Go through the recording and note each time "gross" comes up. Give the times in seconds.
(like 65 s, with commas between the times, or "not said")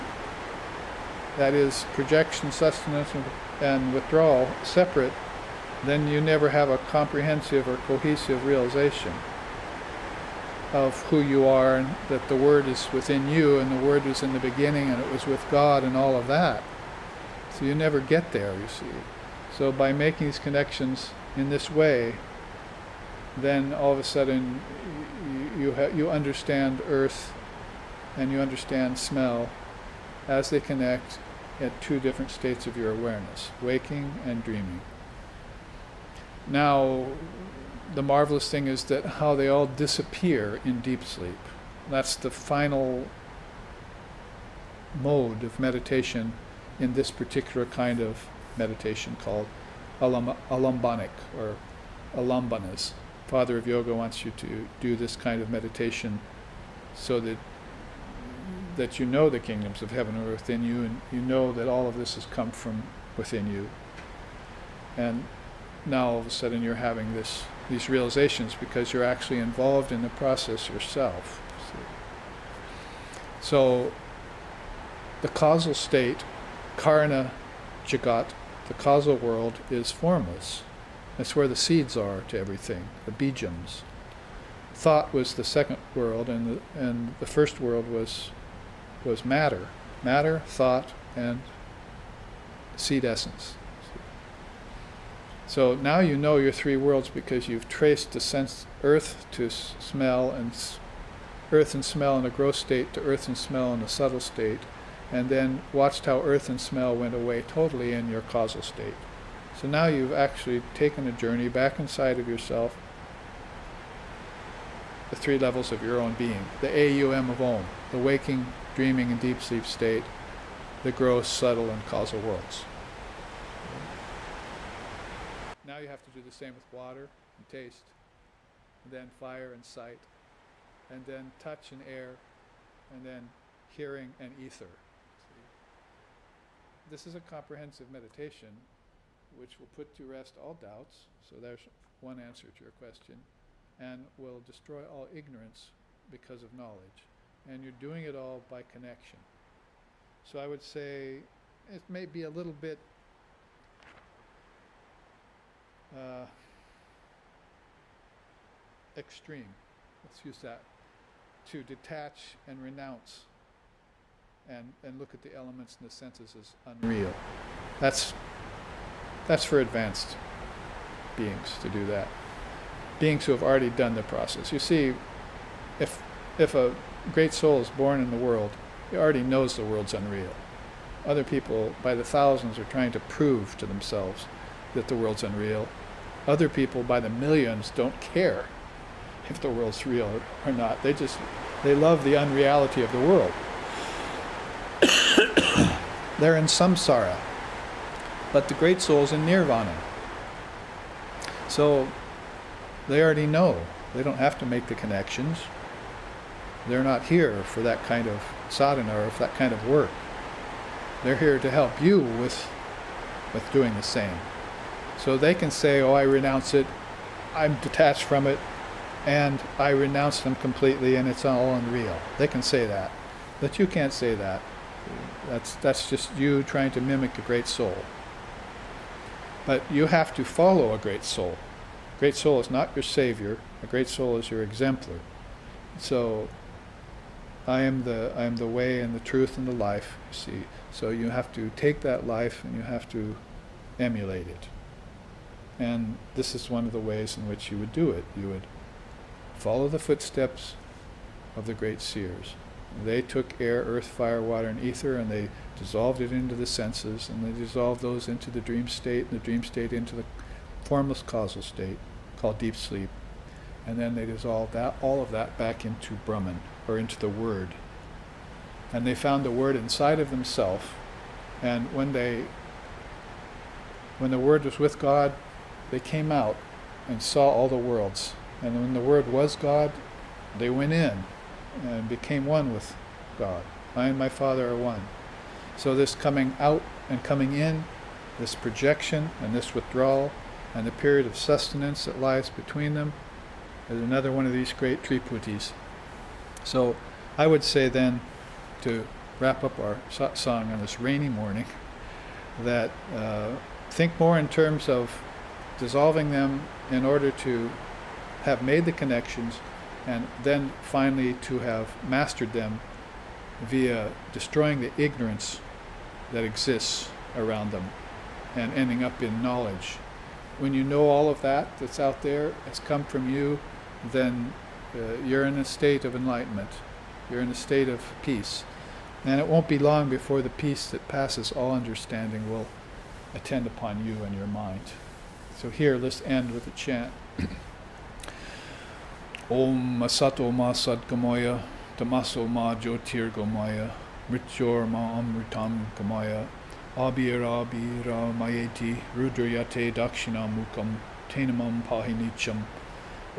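102 s, 120 s.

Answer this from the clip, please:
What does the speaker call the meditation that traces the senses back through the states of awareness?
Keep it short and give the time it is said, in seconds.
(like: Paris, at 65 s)
alambanas, at 52 s.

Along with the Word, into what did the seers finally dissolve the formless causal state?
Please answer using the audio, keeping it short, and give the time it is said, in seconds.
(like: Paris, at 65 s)
Brahman, at 266 s.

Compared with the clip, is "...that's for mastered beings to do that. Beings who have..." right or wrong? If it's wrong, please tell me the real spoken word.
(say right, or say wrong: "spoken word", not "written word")
wrong: "advanced", not "mastered".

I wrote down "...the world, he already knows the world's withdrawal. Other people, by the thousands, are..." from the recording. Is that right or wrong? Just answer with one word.
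wrong.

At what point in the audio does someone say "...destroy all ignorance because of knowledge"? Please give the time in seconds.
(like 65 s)
144 s.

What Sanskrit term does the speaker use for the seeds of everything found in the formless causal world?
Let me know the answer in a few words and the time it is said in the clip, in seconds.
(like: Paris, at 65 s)
bijams, at 83 s.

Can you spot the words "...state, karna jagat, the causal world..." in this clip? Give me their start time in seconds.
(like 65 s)
75 s.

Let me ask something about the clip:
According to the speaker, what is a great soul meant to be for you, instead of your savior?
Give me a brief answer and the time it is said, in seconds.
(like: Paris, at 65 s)
your exemplar, at 234 s.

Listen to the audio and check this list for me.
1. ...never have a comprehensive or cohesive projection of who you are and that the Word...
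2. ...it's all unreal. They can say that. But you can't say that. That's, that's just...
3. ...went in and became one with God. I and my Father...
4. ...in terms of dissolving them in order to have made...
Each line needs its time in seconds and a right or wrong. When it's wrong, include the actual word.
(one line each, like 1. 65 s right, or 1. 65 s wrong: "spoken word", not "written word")
1. 6 s wrong: "realization", not "projection"
2. 221 s right
3. 280 s right
4. 304 s right.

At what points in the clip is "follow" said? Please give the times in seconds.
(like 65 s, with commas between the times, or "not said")
230 s, 249 s.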